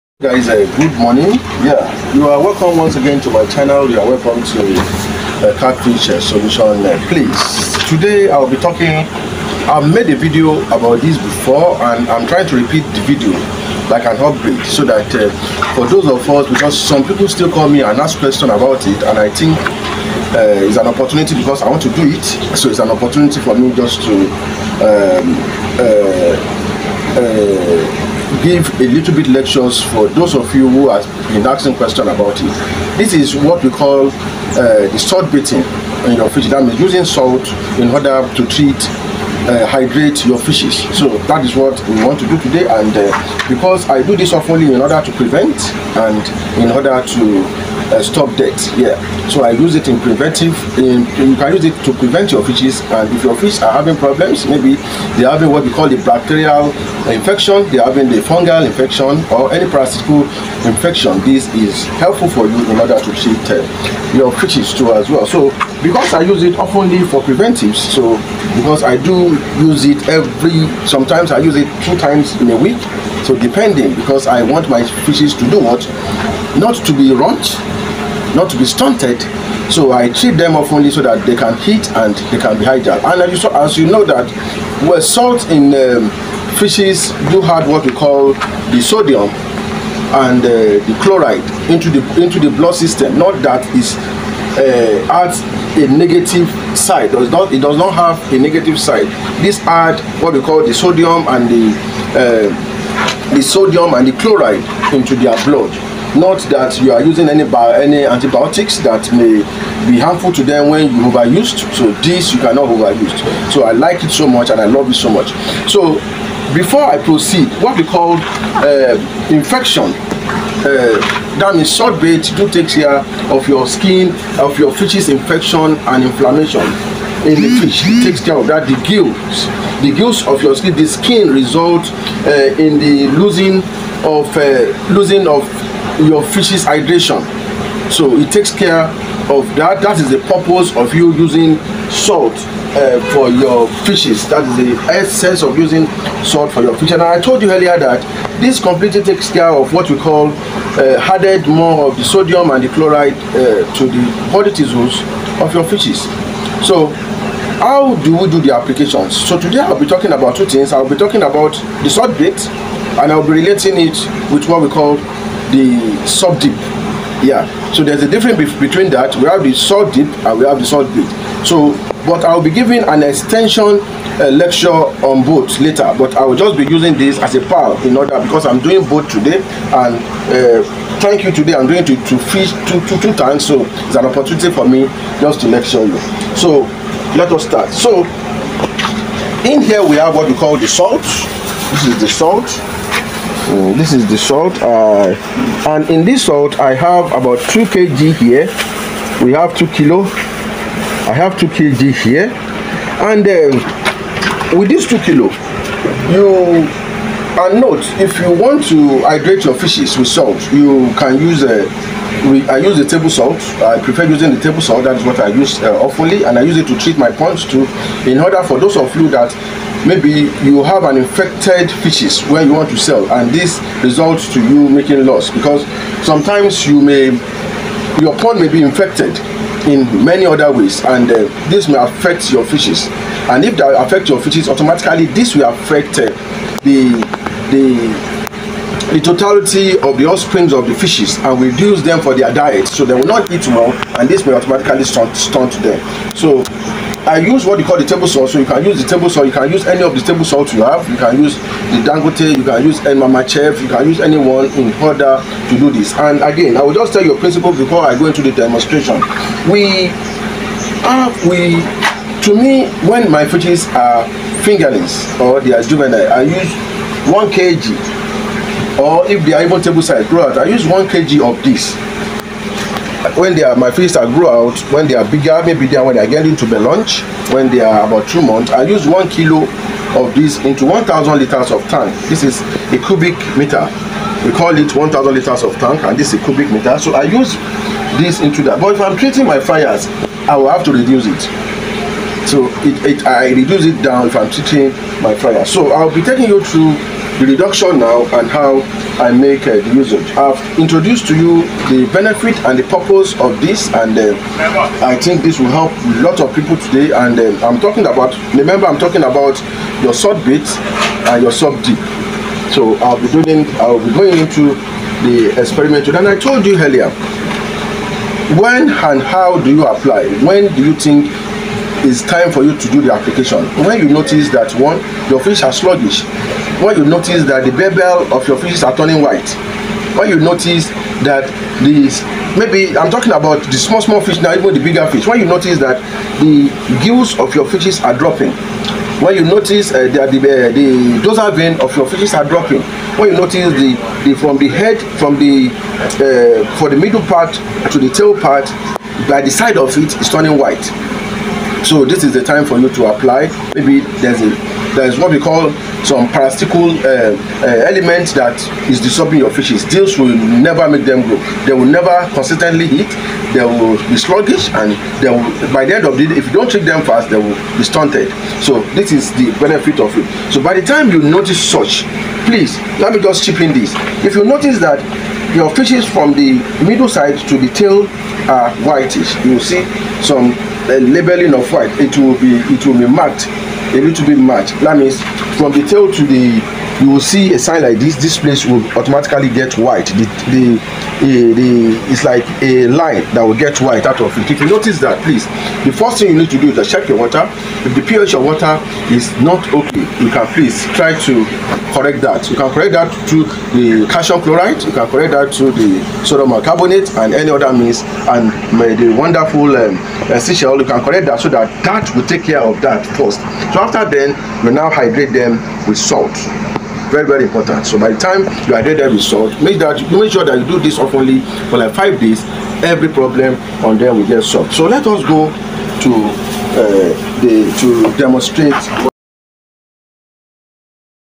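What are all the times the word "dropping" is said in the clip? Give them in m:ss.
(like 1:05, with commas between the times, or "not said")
5:37, 5:42.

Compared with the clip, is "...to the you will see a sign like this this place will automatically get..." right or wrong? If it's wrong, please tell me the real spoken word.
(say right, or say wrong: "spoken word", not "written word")
right.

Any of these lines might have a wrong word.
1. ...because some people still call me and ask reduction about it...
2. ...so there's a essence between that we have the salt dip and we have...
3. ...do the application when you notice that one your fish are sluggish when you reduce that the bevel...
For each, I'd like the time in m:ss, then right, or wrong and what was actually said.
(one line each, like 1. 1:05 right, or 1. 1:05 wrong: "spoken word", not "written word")
1. 0:16 wrong: "question", not "reduction"
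2. 2:47 wrong: "difference", not "essence"
3. 5:22 wrong: "notice", not "reduce".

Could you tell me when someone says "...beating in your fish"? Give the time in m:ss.
0:35.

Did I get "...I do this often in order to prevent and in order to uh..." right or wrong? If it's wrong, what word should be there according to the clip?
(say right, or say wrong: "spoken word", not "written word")
right.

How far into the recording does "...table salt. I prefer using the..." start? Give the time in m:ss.
3:32.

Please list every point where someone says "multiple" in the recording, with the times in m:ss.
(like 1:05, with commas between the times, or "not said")
not said.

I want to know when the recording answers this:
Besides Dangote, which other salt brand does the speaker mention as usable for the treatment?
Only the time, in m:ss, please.
4:12.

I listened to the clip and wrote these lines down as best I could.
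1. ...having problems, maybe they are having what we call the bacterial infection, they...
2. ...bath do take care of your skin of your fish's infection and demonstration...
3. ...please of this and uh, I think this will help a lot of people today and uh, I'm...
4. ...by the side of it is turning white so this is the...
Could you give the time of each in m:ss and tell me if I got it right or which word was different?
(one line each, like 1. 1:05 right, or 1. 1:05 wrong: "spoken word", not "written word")
1. 0:53 right
2. 2:02 wrong: "inflammation", not "demonstration"
3. 5:02 wrong: "purpose", not "please"
4. 5:49 right.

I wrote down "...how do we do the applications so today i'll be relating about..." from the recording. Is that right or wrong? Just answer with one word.
wrong.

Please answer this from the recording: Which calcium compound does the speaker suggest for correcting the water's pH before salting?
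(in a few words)
calcium chloride.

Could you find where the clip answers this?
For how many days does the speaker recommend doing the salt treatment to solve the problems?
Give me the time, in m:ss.
7:01.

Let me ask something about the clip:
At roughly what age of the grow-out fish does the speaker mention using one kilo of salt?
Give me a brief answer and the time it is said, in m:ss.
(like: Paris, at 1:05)
two months, at 4:37.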